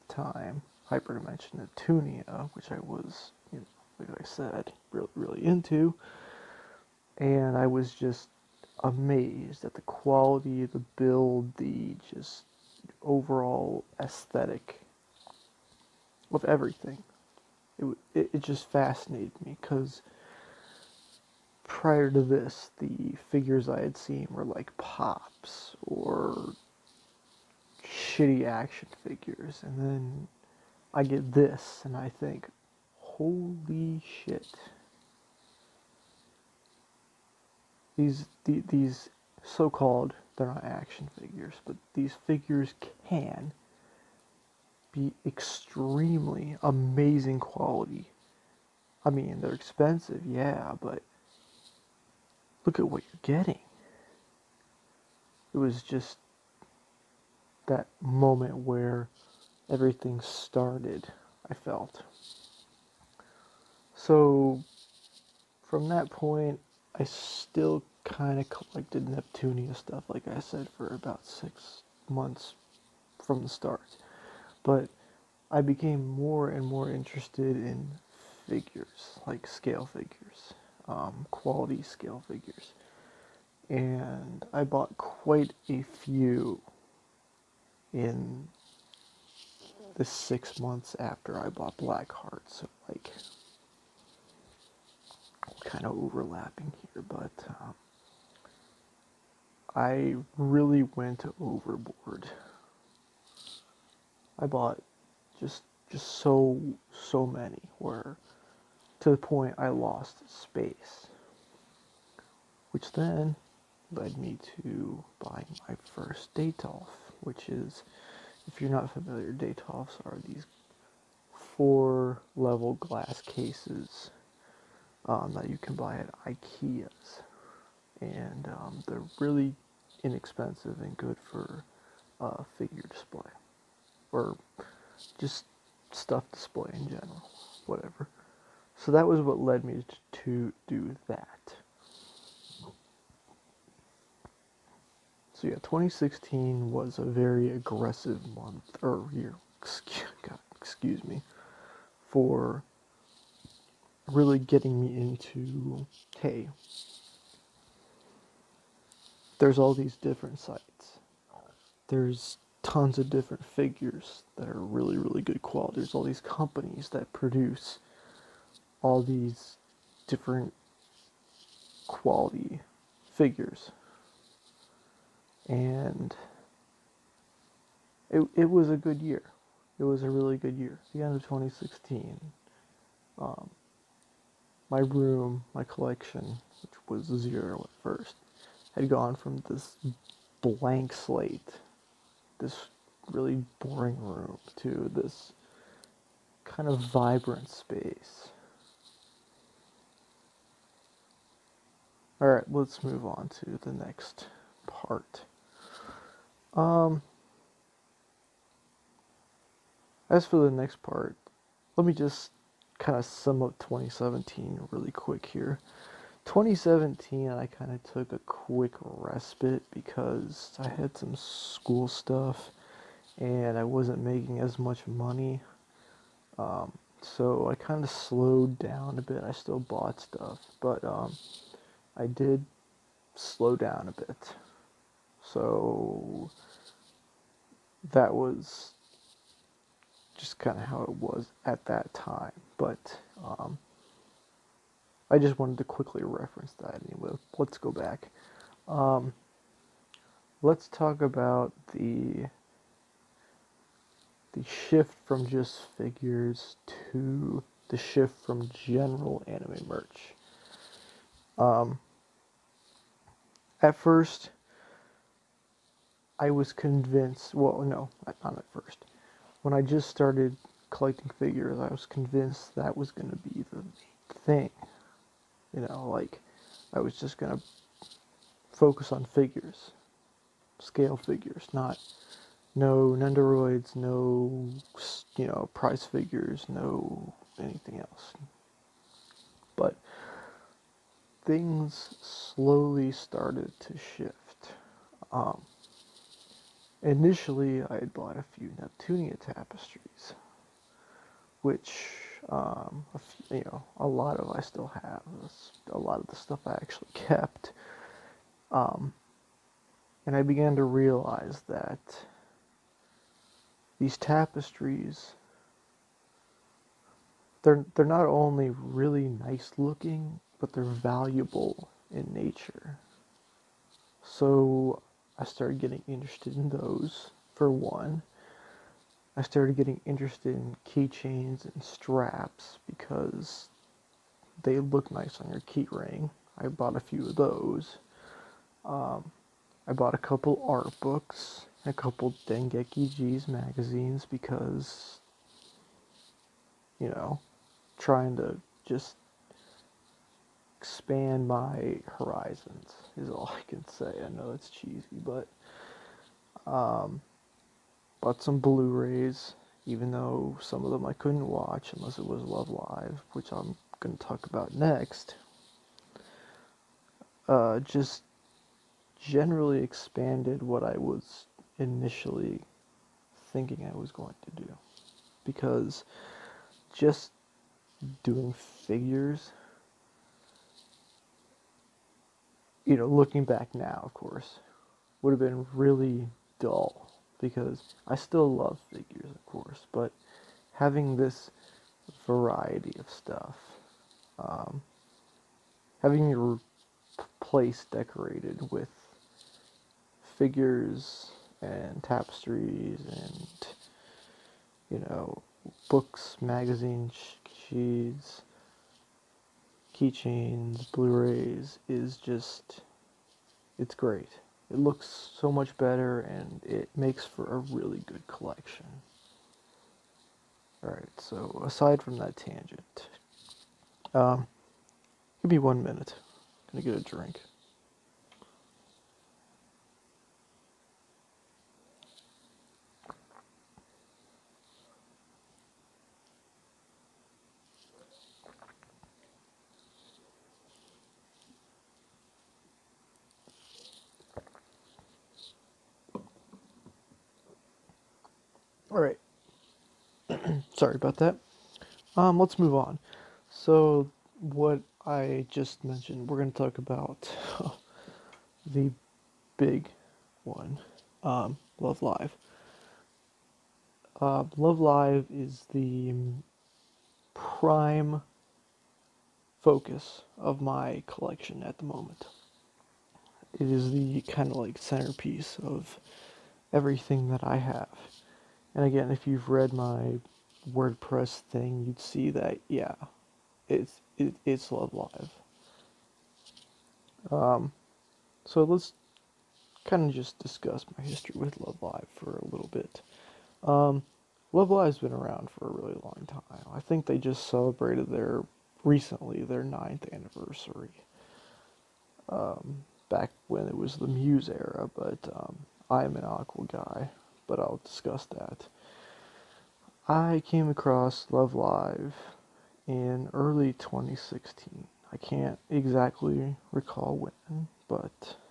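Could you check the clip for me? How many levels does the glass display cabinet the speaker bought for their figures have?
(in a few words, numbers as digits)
4.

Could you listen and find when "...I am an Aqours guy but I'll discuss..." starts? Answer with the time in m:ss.
8:25.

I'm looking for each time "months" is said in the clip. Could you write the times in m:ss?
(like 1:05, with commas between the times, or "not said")
1:12, 1:30, 2:28.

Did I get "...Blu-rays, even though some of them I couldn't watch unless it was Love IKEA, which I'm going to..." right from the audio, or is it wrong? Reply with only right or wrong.
wrong.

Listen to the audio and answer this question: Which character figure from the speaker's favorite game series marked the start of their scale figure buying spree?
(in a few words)
Blackheart.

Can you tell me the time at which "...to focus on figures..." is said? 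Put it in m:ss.
4:37.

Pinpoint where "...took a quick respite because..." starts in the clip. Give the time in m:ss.
3:37.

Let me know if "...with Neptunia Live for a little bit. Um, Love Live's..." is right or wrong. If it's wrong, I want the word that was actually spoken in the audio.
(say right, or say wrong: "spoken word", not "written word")
wrong: "Love", not "Neptunia".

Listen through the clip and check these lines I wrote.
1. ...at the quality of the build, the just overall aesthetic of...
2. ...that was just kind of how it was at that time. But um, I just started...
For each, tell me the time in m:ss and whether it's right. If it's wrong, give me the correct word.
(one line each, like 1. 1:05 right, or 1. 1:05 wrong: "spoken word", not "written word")
1. 0:09 right
2. 3:57 wrong: "wanted", not "started".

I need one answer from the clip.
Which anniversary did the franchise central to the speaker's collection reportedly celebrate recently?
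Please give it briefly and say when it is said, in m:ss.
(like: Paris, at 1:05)
Ninth, at 8:19.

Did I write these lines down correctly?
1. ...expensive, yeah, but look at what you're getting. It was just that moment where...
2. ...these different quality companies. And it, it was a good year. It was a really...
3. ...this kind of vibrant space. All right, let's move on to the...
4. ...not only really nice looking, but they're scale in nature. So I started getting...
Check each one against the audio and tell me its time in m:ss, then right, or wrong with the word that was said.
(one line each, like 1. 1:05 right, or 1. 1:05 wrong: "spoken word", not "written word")
1. 0:49 right
2. 2:49 wrong: "figures", not "companies"
3. 3:14 right
4. 5:17 wrong: "valuable", not "scale".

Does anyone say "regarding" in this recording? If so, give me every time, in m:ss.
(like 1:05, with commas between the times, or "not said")
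not said.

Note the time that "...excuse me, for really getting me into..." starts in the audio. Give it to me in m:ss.
2:30.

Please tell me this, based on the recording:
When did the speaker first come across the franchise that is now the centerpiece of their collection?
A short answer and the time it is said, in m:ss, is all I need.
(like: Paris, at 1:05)
Early 2016, at 8:33.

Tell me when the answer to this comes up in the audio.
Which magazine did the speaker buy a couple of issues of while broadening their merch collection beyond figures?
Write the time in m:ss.
5:42.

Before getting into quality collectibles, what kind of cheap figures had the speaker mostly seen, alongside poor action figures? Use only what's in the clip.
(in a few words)
Pops.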